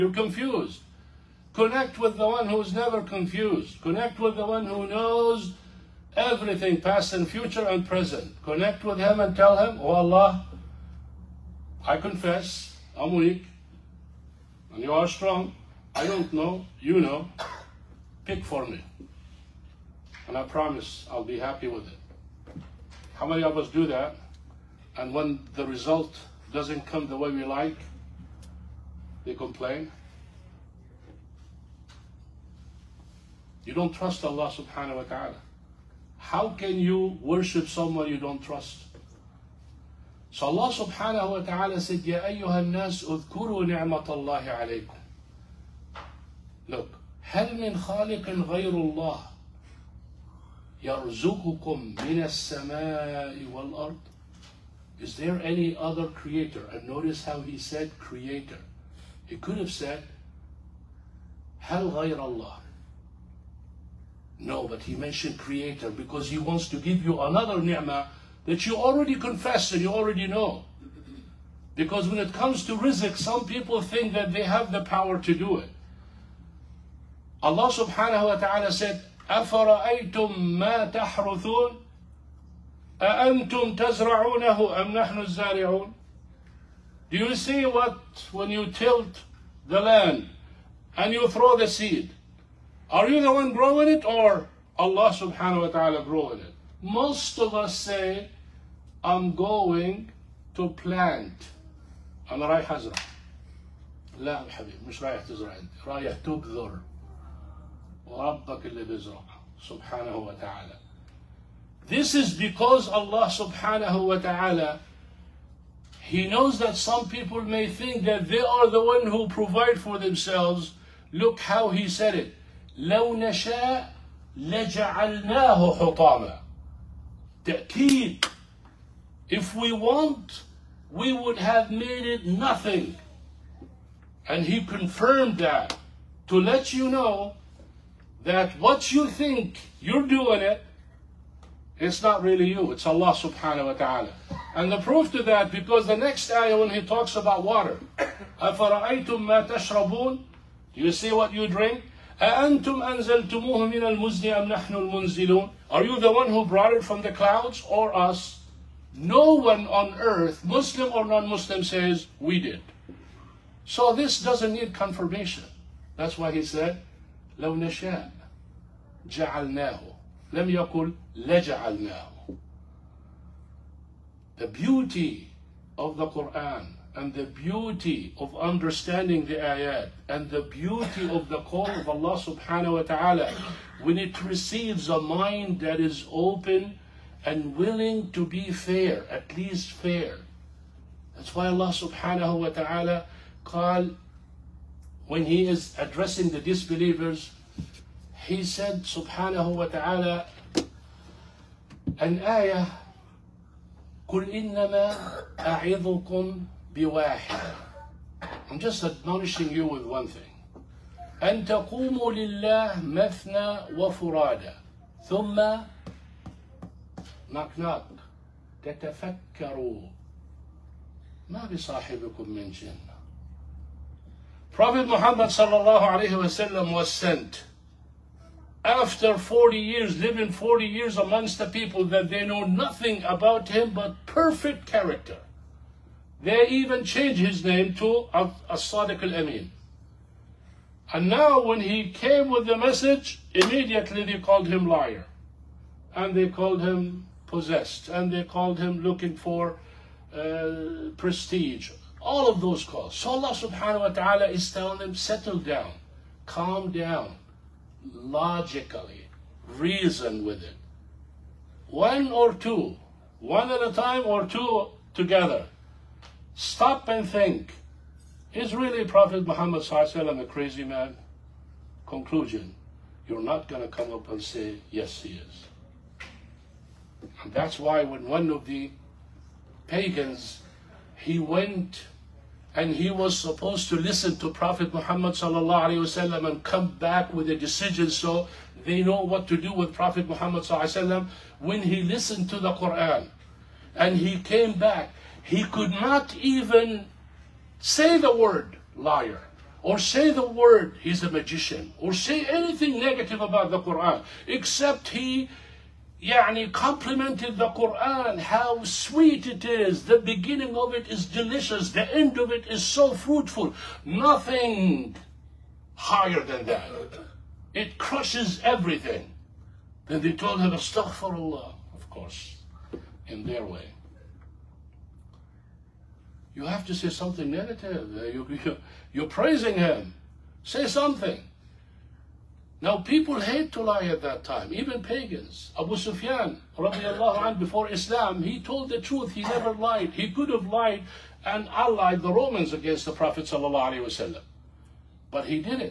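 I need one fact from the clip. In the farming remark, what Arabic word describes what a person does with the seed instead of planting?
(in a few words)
تبذر.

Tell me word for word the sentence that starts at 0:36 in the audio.
How can you worship someone you don't trust?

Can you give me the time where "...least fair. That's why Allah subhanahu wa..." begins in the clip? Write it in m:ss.
3:09.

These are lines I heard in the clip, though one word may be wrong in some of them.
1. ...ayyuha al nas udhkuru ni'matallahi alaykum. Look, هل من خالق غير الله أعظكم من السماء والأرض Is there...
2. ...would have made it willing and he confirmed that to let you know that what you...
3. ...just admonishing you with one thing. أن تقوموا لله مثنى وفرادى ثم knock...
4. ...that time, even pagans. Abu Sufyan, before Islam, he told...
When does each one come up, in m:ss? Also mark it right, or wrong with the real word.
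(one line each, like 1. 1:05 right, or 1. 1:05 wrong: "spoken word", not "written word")
1. 0:42 wrong: "يرزقكم", not "أعظكم"
2. 2:11 wrong: "nothing", not "willing"
3. 3:28 right
4. 5:34 right.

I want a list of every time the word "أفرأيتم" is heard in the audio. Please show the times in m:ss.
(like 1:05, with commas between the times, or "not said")
1:19, 2:28.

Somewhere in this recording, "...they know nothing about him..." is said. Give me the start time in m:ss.
3:52.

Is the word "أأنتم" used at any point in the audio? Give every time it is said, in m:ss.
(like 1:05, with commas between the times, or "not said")
1:23, 2:32.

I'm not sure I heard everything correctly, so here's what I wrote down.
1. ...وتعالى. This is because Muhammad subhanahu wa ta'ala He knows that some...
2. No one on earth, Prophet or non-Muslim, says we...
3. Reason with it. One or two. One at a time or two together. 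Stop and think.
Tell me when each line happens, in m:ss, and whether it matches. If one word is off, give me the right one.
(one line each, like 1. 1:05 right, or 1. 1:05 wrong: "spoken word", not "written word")
1. 1:50 wrong: "Allah", not "Muhammad"
2. 2:38 wrong: "Muslim", not "Prophet"
3. 4:19 right.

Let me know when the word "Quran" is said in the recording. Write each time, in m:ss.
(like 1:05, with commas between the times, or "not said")
2:56, 4:52, 5:03, 5:07.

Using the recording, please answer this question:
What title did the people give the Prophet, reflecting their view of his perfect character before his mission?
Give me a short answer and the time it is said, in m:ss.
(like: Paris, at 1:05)
As-Sadiq al-Amin, at 3:58.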